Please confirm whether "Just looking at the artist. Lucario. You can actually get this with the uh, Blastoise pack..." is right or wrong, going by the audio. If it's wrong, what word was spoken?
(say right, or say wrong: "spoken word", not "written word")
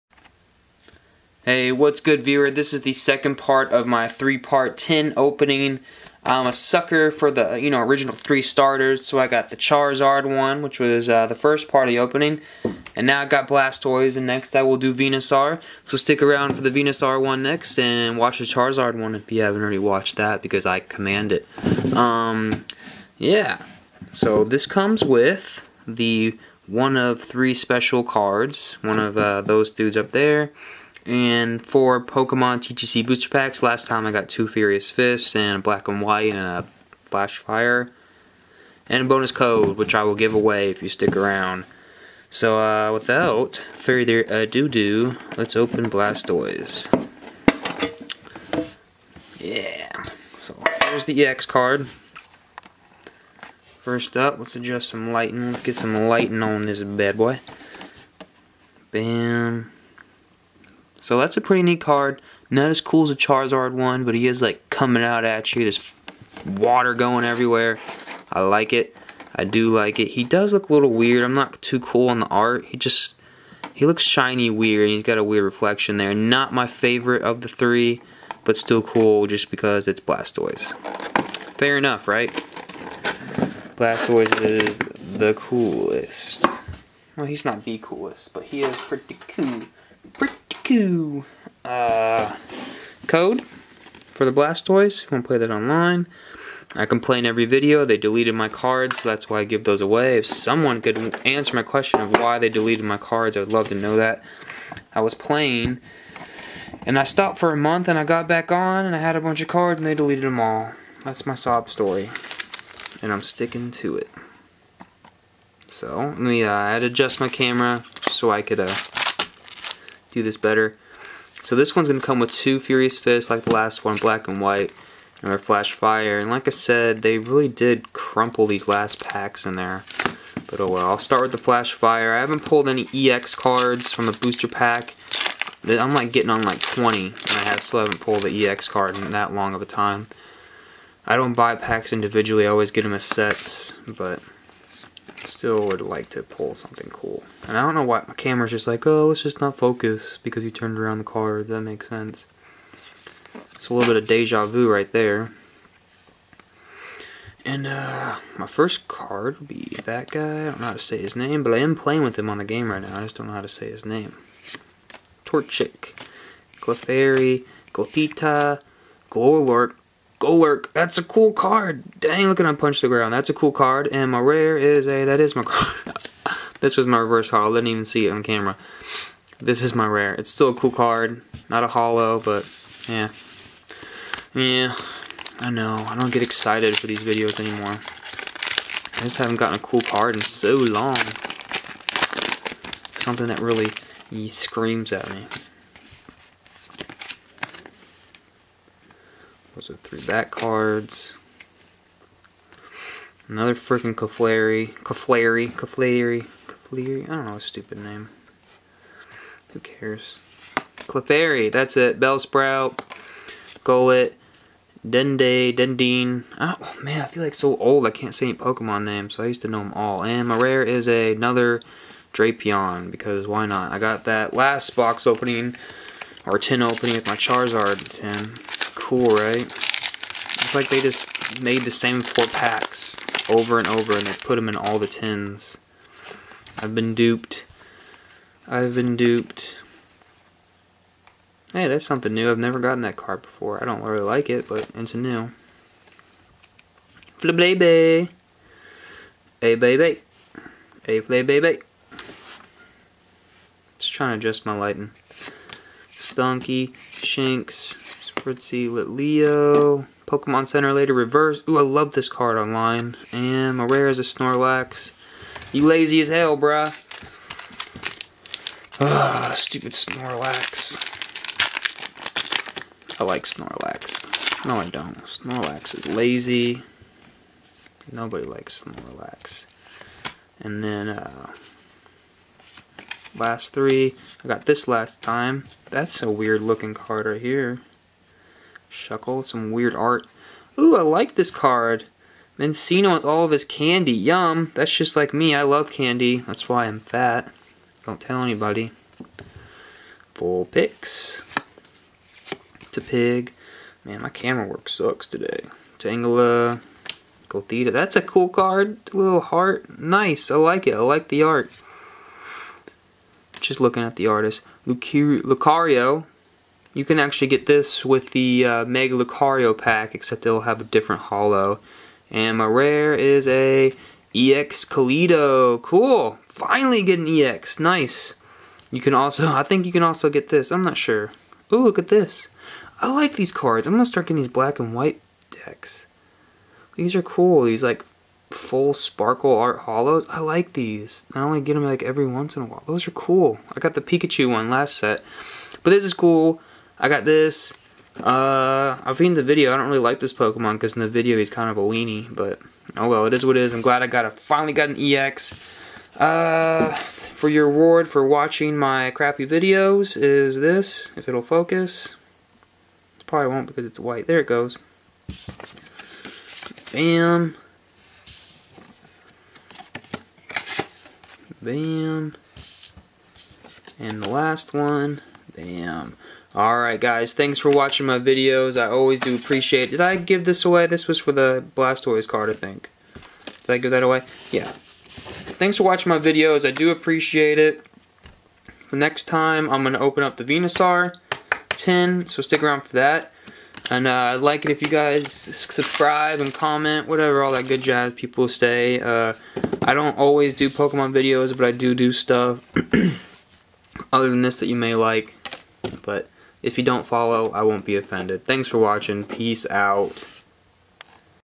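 wrong: "Lucario", not "Blastoise".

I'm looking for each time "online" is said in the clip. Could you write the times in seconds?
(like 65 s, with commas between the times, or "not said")
95 s, 262 s.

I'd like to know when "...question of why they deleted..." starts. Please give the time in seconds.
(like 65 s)
101 s.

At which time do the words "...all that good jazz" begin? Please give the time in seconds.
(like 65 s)
397 s.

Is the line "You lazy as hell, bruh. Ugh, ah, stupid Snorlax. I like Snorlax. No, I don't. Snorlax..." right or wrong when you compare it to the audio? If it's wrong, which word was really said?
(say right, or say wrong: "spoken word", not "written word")
right.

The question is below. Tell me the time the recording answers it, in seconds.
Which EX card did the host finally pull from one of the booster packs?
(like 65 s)
324 s.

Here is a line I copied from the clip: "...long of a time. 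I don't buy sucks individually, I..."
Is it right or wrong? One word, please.
wrong.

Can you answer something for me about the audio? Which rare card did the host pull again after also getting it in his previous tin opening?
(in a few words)
Drapion.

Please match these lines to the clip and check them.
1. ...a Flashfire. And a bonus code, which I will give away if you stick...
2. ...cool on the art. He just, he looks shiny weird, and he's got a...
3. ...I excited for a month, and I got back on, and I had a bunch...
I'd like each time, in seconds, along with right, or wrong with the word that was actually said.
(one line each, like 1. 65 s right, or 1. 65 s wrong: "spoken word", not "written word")
1. 36 s right
2. 71 s right
3. 106 s wrong: "stopped", not "excited".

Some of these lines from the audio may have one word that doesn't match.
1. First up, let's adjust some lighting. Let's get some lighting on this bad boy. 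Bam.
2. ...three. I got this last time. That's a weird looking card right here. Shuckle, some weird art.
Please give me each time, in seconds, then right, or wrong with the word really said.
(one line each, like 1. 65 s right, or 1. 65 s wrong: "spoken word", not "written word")
1. 53 s right
2. 283 s right.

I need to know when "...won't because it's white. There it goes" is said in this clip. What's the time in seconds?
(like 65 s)
363 s.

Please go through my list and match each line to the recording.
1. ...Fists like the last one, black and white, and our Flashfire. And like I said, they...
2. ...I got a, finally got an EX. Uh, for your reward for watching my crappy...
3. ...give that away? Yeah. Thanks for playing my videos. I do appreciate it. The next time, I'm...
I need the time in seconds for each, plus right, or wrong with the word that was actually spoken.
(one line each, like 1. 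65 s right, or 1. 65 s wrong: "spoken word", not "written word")
1. 122 s right
2. 353 s right
3. 383 s wrong: "watching", not "playing".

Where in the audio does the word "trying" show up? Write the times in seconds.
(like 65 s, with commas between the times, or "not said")
253 s.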